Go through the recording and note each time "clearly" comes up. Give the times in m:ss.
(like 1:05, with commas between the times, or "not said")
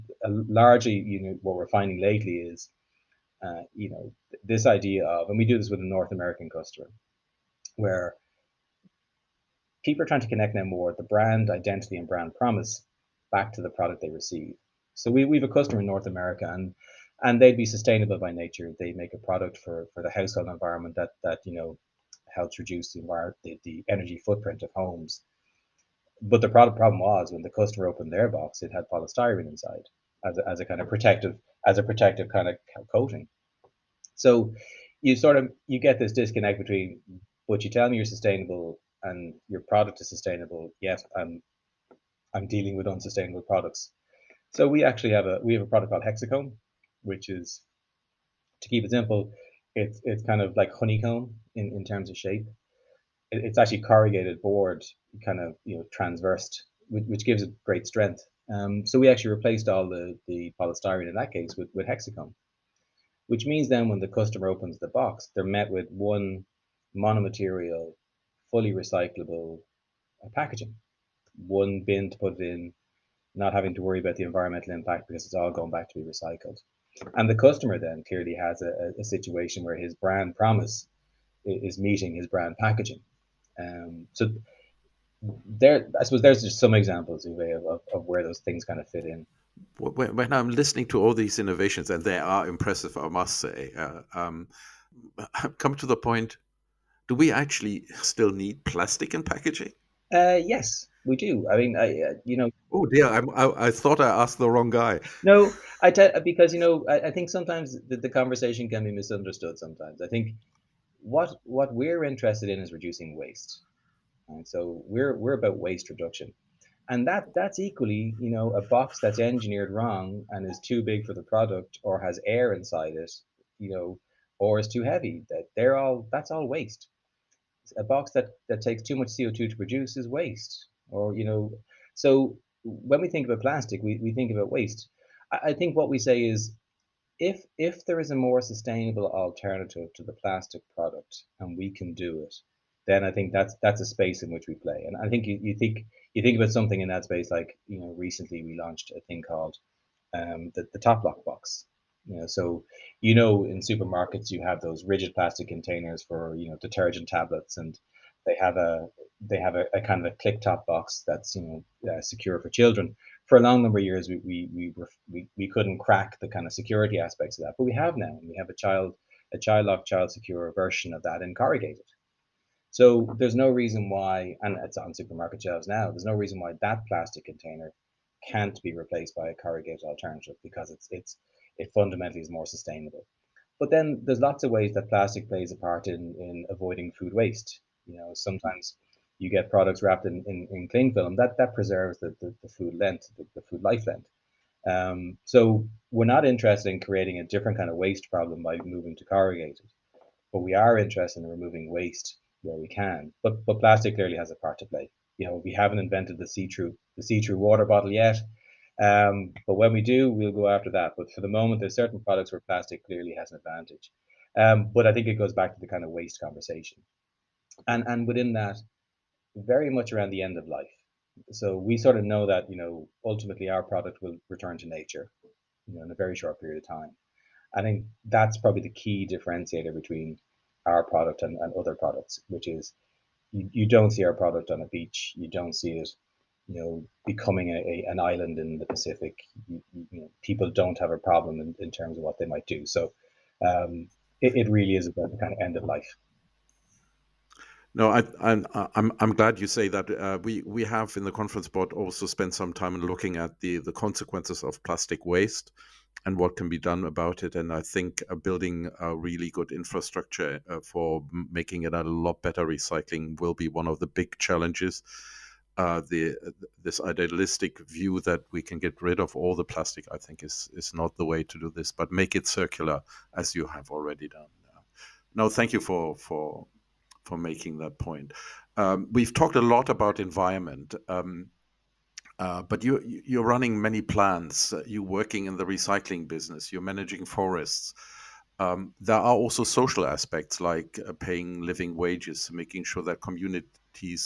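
1:18, 3:23, 3:32.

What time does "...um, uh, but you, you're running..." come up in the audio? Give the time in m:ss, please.
4:40.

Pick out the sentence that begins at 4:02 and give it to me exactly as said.
So um, it, it really is about the kind of end of life.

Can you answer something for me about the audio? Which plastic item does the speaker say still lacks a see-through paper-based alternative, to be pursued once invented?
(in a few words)
Water bottle.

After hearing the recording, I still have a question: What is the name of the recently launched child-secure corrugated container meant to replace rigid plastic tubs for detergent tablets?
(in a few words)
Top lock box.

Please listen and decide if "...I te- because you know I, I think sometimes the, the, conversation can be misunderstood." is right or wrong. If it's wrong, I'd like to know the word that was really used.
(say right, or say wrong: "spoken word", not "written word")
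right.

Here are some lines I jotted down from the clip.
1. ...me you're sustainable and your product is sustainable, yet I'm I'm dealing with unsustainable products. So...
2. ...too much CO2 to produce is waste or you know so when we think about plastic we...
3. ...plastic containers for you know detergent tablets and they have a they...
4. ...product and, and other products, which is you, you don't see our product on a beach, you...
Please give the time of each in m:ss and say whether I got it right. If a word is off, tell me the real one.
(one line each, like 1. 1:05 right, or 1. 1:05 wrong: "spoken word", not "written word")
1. 0:37 right
2. 2:08 right
3. 2:35 right
4. 3:50 right.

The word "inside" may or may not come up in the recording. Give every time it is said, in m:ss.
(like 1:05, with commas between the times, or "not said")
0:29, 2:02.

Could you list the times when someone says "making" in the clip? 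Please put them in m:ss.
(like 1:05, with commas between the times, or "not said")
4:21, 4:37, 4:52.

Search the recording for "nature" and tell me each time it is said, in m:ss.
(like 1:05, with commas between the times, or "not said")
0:18, 3:44.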